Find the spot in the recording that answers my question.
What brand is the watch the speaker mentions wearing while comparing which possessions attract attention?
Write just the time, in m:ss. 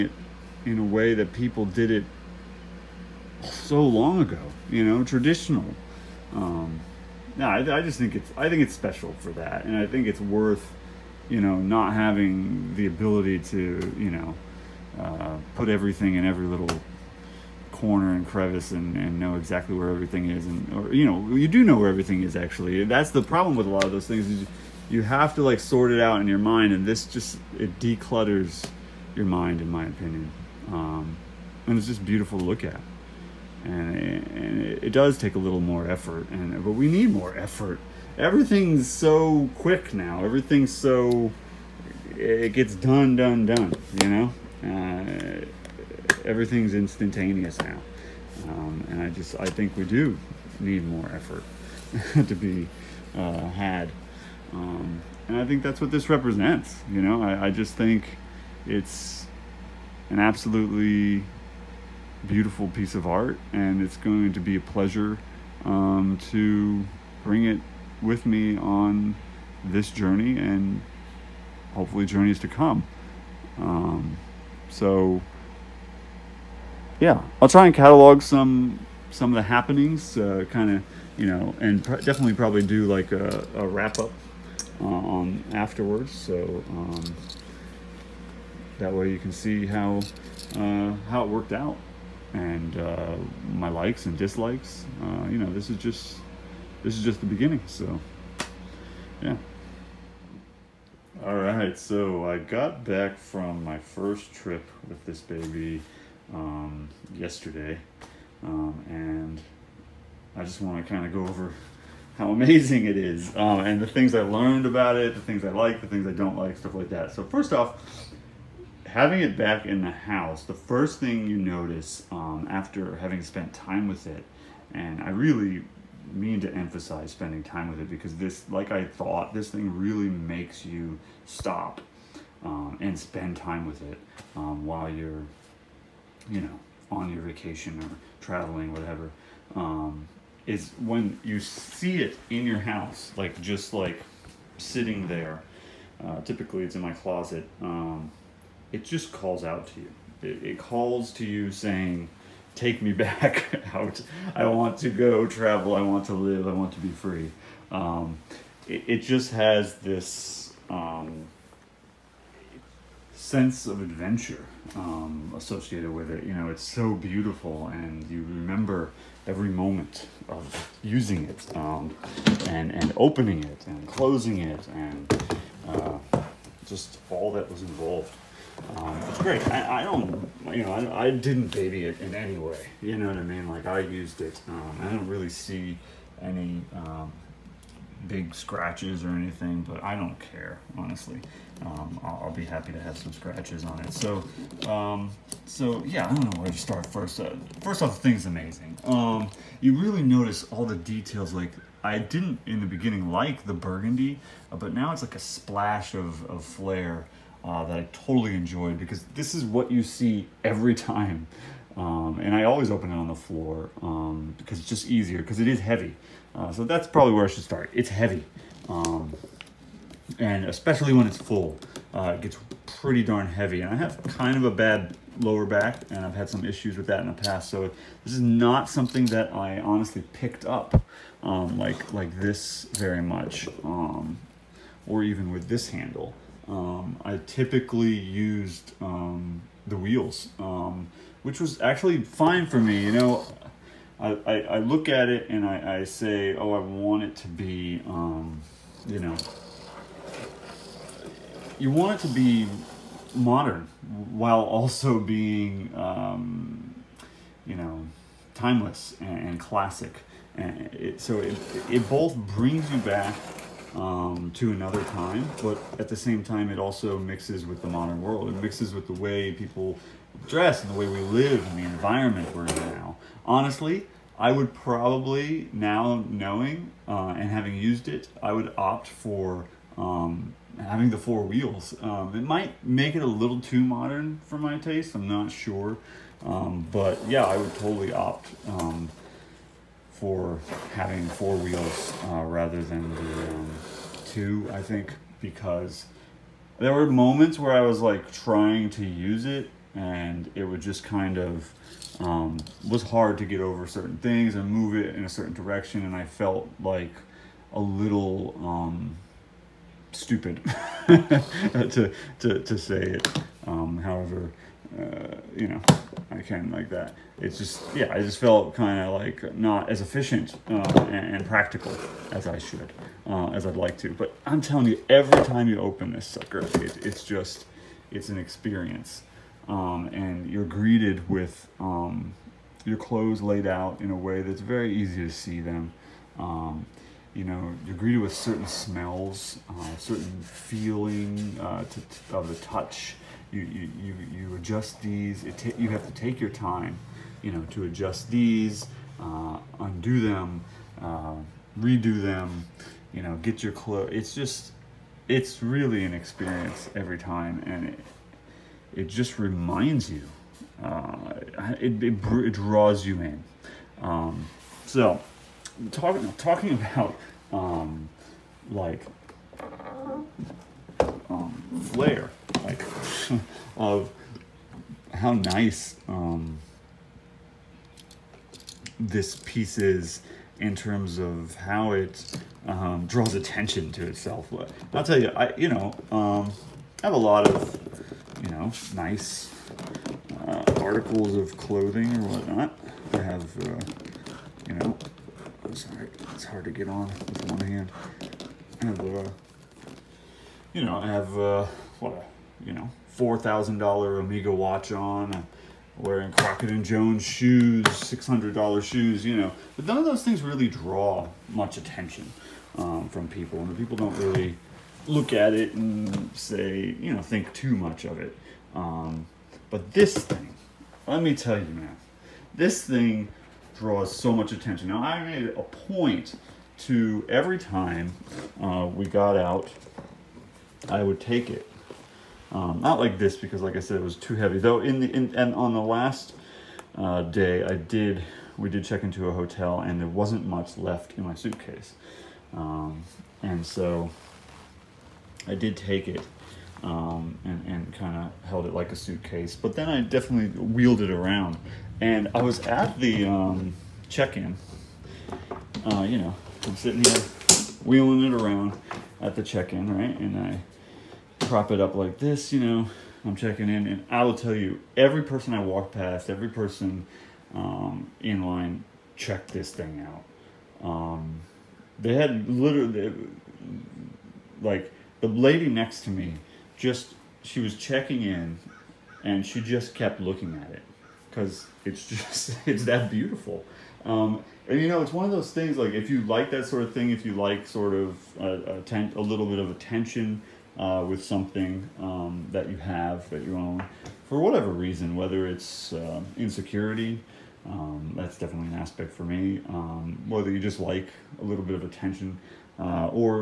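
6:44.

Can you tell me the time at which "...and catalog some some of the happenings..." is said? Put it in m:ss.
1:17.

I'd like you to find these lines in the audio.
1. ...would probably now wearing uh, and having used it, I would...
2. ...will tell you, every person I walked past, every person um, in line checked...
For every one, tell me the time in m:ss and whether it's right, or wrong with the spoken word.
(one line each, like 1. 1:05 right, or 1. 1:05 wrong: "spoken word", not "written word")
1. 4:34 wrong: "knowing", not "wearing"
2. 7:44 right.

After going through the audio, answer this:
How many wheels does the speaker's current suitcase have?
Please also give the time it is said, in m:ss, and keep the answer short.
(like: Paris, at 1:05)
2, at 4:54.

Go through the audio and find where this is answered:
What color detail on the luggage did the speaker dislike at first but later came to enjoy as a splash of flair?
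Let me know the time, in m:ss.
3:23.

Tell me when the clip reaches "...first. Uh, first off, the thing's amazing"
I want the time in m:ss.
3:16.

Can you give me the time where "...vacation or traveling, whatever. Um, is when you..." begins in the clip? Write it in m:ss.
2:17.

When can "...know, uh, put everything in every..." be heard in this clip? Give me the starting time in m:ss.
0:14.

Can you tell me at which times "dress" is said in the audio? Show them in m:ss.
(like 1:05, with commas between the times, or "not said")
4:30.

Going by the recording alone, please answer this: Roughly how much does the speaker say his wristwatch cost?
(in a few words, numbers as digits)
$4,000.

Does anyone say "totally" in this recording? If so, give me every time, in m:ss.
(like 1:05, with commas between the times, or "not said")
3:27, 4:47.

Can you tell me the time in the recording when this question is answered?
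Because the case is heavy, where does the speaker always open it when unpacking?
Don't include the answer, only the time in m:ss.
3:32.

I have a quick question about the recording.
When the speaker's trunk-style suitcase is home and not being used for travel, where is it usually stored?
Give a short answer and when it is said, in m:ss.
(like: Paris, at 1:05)
closet, at 2:26.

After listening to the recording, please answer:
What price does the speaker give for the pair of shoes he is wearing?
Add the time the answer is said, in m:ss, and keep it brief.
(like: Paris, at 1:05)
$600, at 6:47.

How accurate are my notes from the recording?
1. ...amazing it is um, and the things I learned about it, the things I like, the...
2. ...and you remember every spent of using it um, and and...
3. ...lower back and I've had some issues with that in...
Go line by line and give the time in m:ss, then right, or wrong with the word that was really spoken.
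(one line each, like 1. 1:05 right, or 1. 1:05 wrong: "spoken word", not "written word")
1. 1:52 right
2. 2:47 wrong: "moment", not "spent"
3. 3:45 right.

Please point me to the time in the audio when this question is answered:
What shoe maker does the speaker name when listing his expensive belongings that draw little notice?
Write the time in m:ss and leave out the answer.
6:46.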